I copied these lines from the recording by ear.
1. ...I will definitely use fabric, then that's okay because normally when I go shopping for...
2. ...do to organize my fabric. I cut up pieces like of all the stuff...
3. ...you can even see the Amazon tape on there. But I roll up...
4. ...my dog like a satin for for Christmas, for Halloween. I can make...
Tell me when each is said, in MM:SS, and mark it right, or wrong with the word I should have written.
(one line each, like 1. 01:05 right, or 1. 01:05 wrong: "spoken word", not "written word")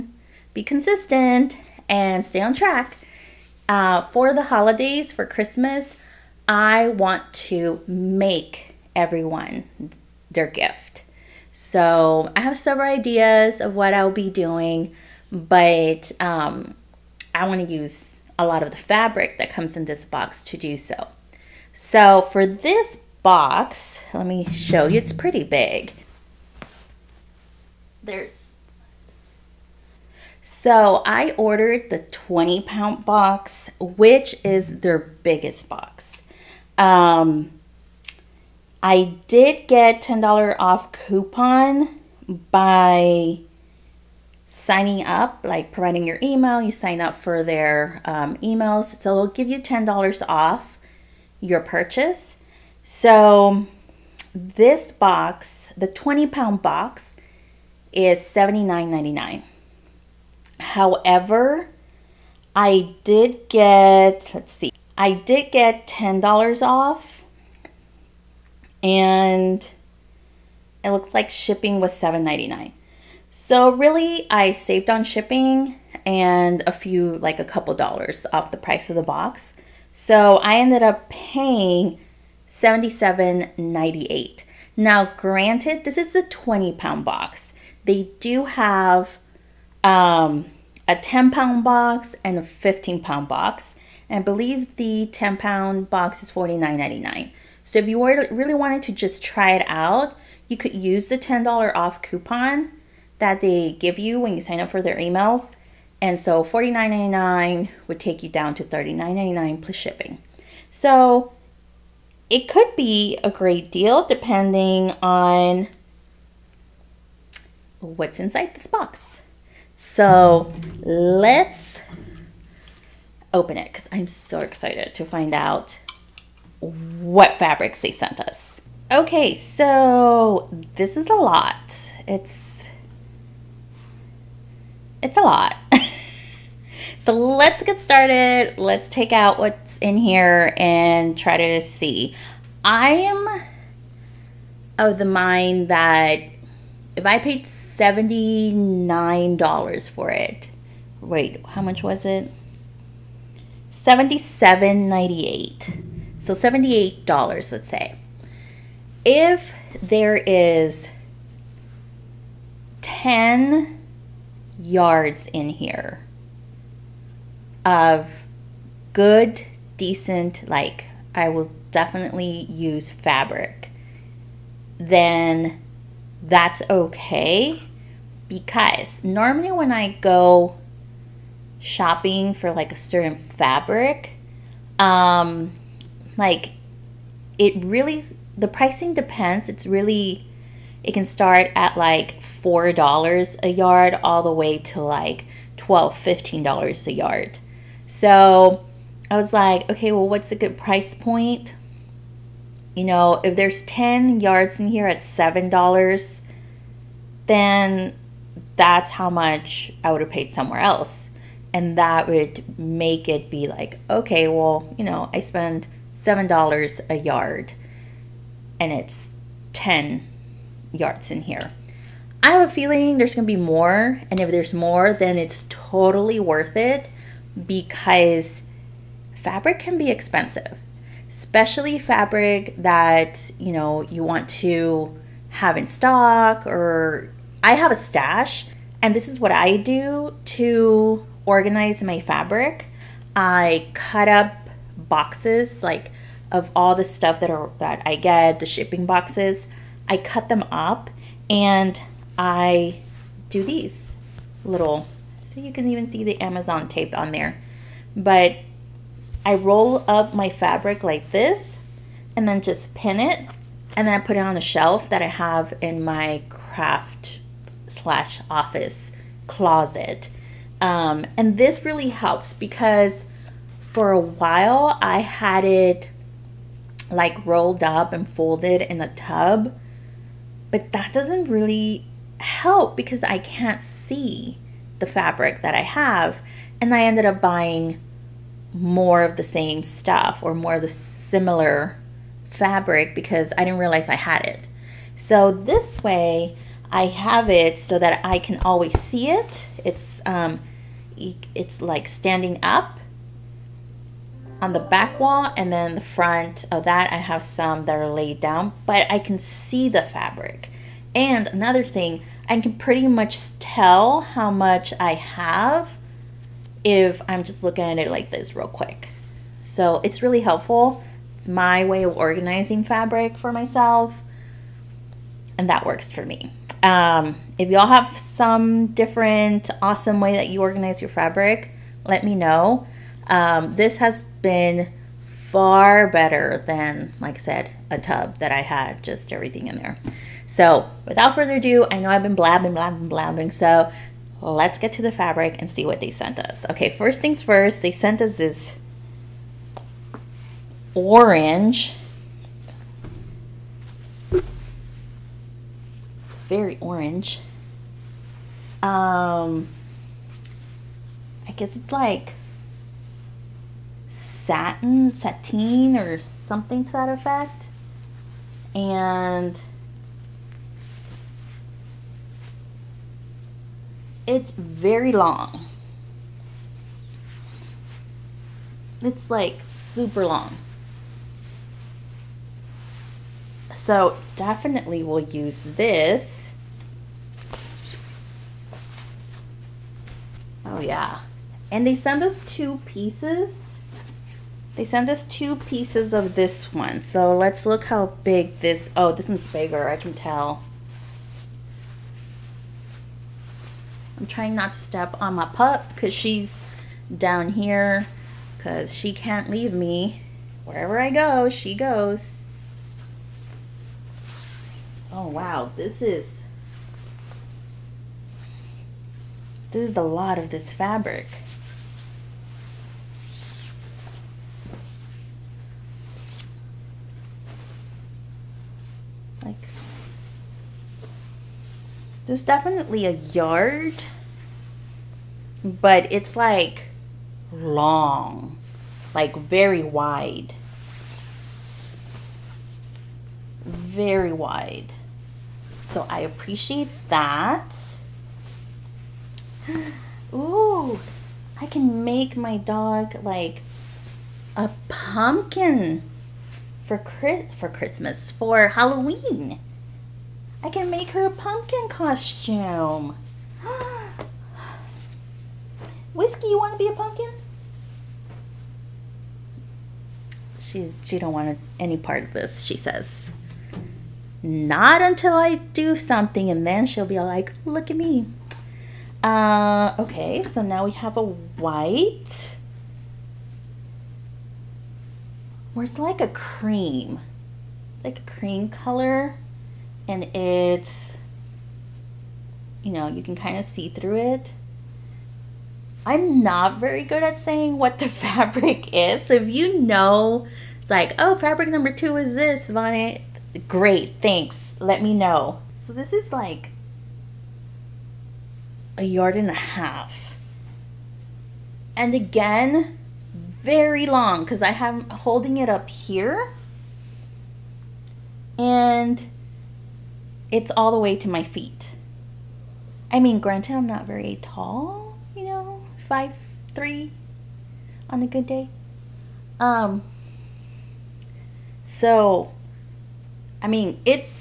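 1. 02:51 right
2. 03:59 wrong: "boxes", not "pieces"
3. 04:15 right
4. 07:32 wrong: "pumpkin", not "satin".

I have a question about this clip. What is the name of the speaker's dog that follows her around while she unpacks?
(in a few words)
Whiskey.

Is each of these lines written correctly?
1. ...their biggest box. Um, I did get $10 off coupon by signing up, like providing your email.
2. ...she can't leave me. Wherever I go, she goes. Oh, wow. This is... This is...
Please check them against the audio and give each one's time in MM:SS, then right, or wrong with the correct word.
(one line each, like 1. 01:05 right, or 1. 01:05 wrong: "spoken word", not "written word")
1. 00:34 right
2. 06:48 right.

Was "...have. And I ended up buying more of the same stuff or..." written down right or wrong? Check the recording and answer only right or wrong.
right.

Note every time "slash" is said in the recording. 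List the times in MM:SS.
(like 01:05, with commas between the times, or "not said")
04:27.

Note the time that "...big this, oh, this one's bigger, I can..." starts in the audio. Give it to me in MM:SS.
06:38.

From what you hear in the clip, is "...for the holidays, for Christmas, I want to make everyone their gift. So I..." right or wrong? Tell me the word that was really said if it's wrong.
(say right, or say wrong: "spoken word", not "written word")
right.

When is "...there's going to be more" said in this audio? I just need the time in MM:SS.
03:42.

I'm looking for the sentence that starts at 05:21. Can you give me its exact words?
It's my way of organizing fabric for myself, and that works for me.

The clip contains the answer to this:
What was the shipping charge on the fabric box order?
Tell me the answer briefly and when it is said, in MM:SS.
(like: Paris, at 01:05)
$7.99, at 01:11.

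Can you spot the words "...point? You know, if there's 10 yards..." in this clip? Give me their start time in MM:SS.
03:20.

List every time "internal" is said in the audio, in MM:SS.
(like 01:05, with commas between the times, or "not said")
not said.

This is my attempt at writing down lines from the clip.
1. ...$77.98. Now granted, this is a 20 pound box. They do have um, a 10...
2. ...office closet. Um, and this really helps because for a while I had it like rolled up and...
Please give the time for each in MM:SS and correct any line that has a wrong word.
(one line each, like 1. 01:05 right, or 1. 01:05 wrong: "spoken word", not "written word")
1. 01:22 right
2. 04:28 right.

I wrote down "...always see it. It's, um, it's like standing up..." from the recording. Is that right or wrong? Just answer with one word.
right.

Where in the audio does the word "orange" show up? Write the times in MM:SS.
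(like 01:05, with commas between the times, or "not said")
05:50, 05:56.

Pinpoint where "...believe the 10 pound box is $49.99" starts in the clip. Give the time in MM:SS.
01:34.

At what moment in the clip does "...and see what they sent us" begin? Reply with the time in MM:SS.
05:45.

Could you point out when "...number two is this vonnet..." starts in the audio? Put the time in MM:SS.
08:21.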